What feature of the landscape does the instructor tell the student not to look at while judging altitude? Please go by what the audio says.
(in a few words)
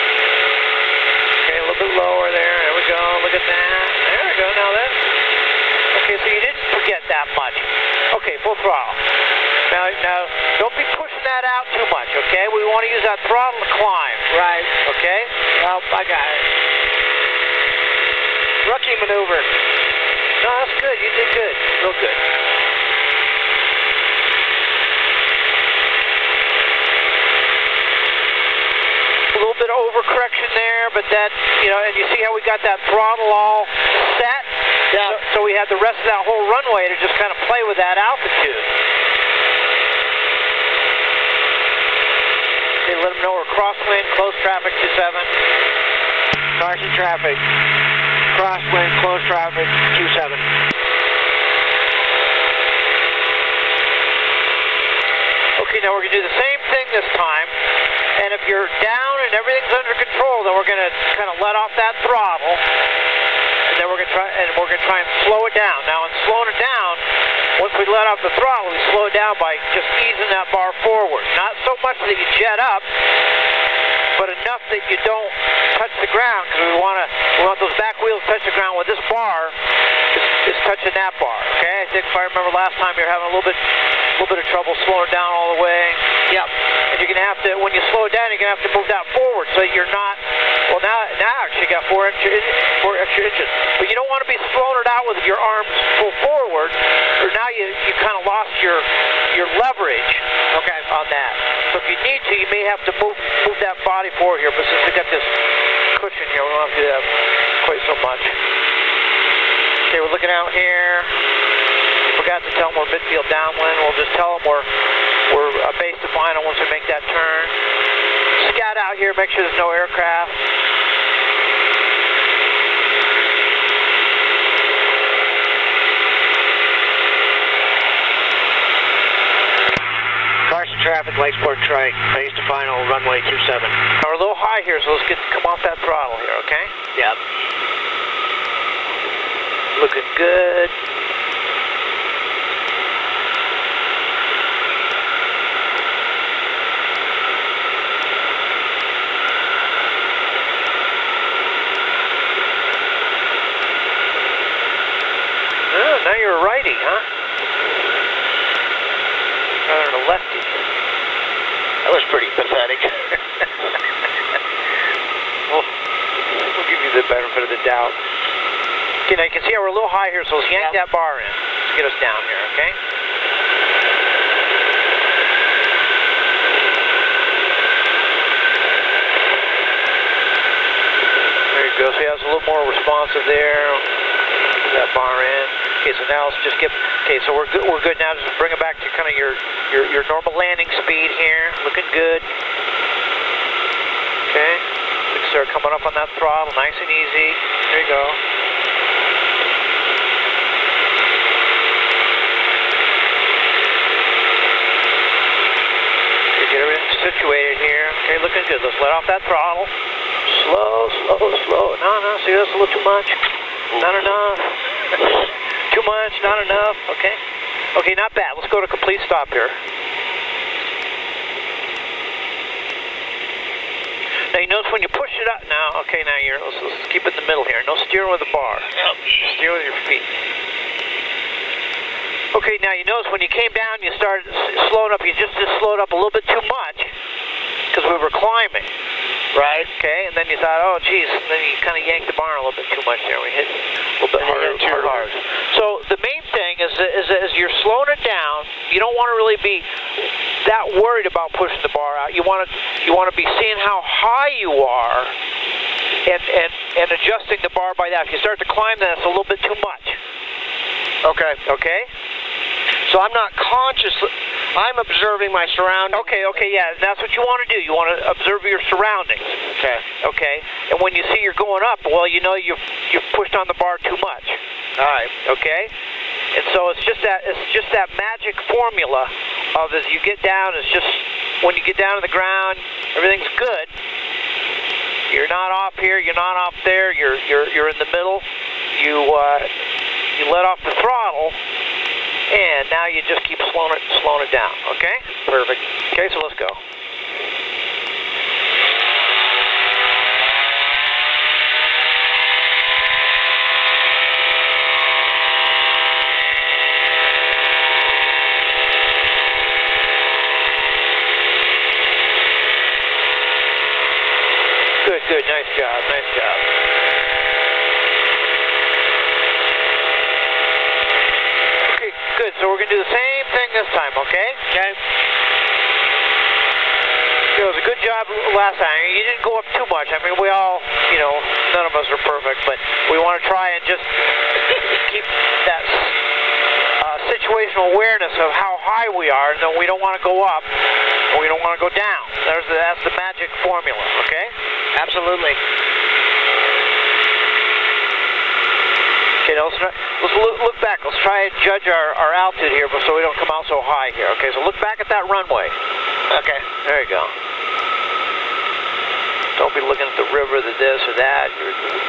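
the river.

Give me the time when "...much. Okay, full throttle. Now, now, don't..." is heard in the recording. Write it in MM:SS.
00:07.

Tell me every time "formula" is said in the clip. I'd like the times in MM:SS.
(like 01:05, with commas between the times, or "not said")
04:38, 05:43.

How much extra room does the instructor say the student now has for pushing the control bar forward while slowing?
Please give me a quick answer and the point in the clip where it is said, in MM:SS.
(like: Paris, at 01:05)
4 inches, at 01:32.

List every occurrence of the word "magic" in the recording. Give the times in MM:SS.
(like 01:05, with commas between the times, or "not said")
04:37, 05:42.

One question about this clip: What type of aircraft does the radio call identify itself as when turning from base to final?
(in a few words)
Light Sport Trike.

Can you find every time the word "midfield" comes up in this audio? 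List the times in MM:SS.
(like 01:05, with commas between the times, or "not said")
01:52.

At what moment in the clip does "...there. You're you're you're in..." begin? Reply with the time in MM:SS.
04:46.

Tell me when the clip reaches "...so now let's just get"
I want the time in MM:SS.
03:05.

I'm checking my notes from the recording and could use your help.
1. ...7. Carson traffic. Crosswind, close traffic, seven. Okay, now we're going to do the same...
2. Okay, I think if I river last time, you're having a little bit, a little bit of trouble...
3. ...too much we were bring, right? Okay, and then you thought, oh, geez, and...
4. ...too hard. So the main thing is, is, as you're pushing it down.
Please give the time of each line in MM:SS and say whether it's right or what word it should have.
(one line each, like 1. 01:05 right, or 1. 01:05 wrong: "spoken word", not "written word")
1. 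00:44 right
2. 01:21 wrong: "remember", not "river"
3. 03:56 wrong: "climbing", not "bring"
4. 04:04 wrong: "slowing", not "pushing".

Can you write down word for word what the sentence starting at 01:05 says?
Now, in slowing it down, once we let off the throttle, we slow down by just easing that bar forward.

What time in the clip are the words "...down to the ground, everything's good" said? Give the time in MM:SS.
04:41.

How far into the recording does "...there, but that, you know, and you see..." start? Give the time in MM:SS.
00:30.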